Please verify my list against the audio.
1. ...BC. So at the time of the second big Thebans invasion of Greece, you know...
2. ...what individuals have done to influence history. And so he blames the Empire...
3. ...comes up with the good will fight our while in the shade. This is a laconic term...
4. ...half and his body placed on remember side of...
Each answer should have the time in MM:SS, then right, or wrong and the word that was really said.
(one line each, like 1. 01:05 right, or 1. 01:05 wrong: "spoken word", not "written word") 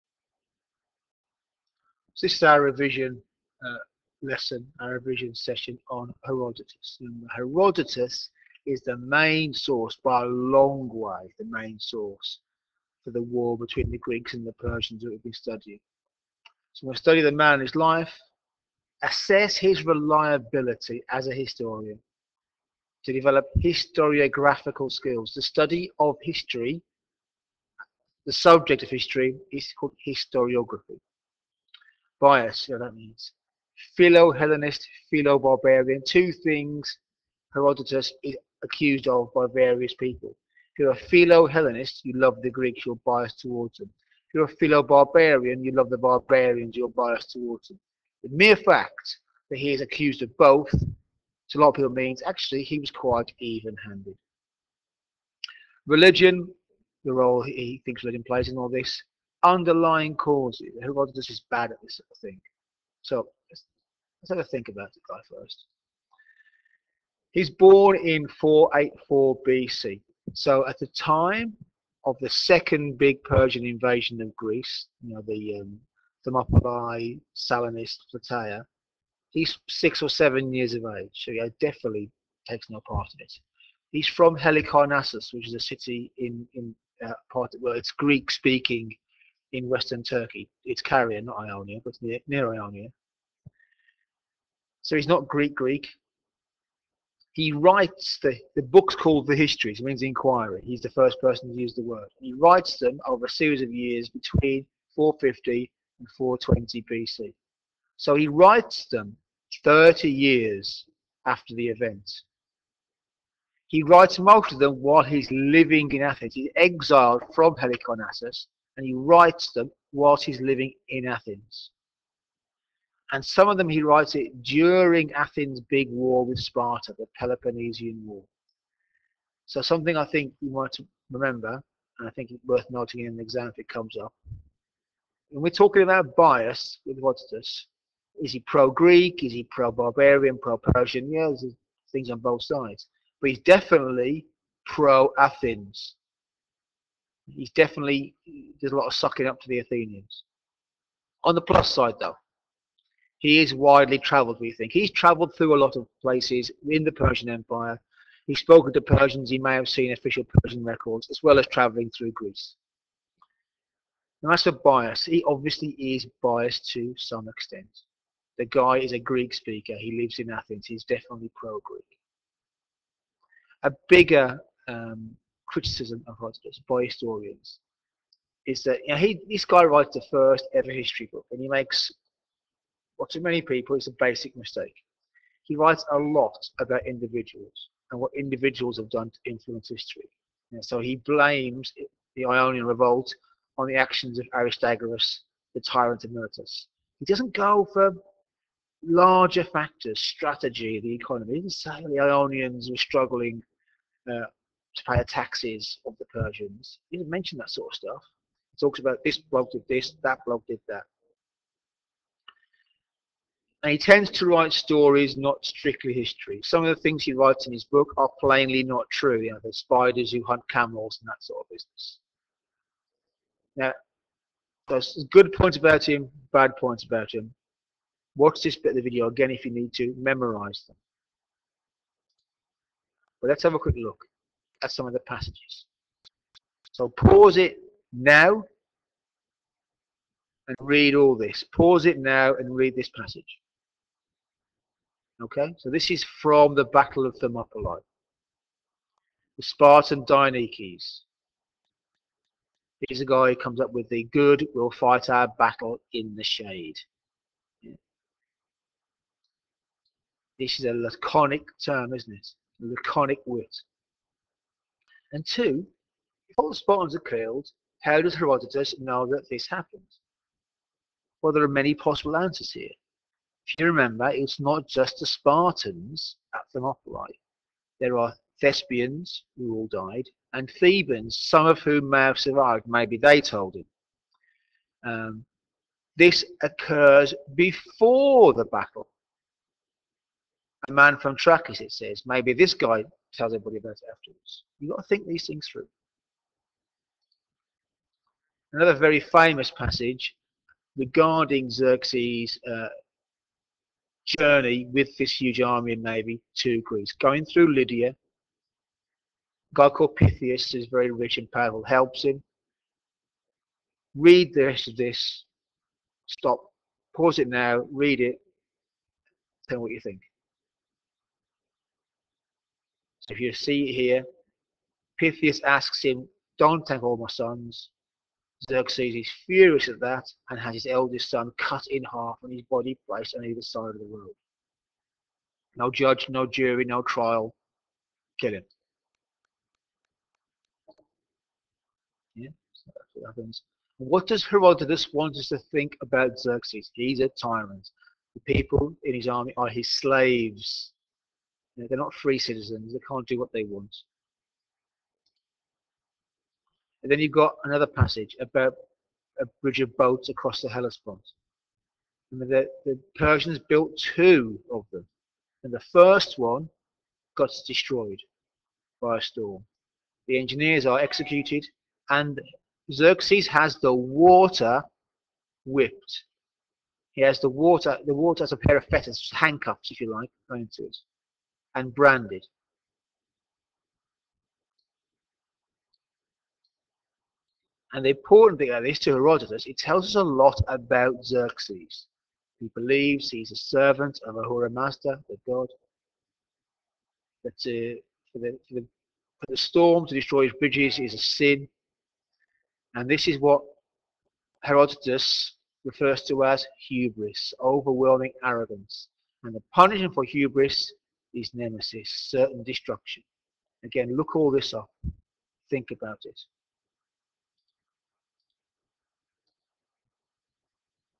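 1. 01:09 wrong: "Persian", not "Thebans"
2. 03:07 wrong: "Ionian", not "Empire"
3. 04:13 wrong: "battle", not "while"
4. 05:31 wrong: "either", not "remember".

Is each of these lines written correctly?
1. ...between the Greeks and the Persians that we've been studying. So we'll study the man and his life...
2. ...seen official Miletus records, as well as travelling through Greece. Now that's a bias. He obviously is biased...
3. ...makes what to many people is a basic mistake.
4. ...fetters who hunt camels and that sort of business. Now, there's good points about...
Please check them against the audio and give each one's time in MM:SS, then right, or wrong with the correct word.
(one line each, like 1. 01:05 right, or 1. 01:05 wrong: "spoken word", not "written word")
1. 00:13 right
2. 02:39 wrong: "Persian", not "Miletus"
3. 03:01 right
4. 03:39 wrong: "spiders", not "fetters".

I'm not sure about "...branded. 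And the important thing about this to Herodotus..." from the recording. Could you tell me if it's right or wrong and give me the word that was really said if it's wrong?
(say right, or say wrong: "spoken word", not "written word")
right.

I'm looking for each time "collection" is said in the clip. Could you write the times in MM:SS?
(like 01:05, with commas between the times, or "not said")
not said.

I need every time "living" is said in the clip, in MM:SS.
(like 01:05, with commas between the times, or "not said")
01:55, 02:00.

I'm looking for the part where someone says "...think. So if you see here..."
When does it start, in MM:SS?
05:19.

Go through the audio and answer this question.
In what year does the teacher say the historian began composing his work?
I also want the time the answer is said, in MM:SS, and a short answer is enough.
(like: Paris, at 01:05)
450 BC, at 01:44.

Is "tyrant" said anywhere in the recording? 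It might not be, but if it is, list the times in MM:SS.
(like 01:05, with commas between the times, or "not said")
03:15, 05:47.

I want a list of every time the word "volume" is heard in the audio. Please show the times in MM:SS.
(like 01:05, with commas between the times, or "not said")
not said.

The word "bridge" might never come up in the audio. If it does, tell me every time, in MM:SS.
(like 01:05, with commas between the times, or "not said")
05:59, 06:40.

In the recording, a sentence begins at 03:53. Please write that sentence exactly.
But let's have a quick look at some of the passages.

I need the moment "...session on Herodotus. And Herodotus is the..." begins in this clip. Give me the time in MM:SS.
00:05.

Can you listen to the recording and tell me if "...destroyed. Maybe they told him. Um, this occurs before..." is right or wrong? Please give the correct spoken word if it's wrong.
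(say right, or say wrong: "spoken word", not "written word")
wrong: "survived", not "destroyed".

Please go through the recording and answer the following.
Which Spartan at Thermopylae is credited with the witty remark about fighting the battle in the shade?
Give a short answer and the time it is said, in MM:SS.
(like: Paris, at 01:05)
Dienekes, at 04:10.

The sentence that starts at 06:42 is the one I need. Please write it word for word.
And this is what Herodotus refers to as hubris, overwhelming arrogance.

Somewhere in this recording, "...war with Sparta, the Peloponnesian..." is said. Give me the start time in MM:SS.
02:05.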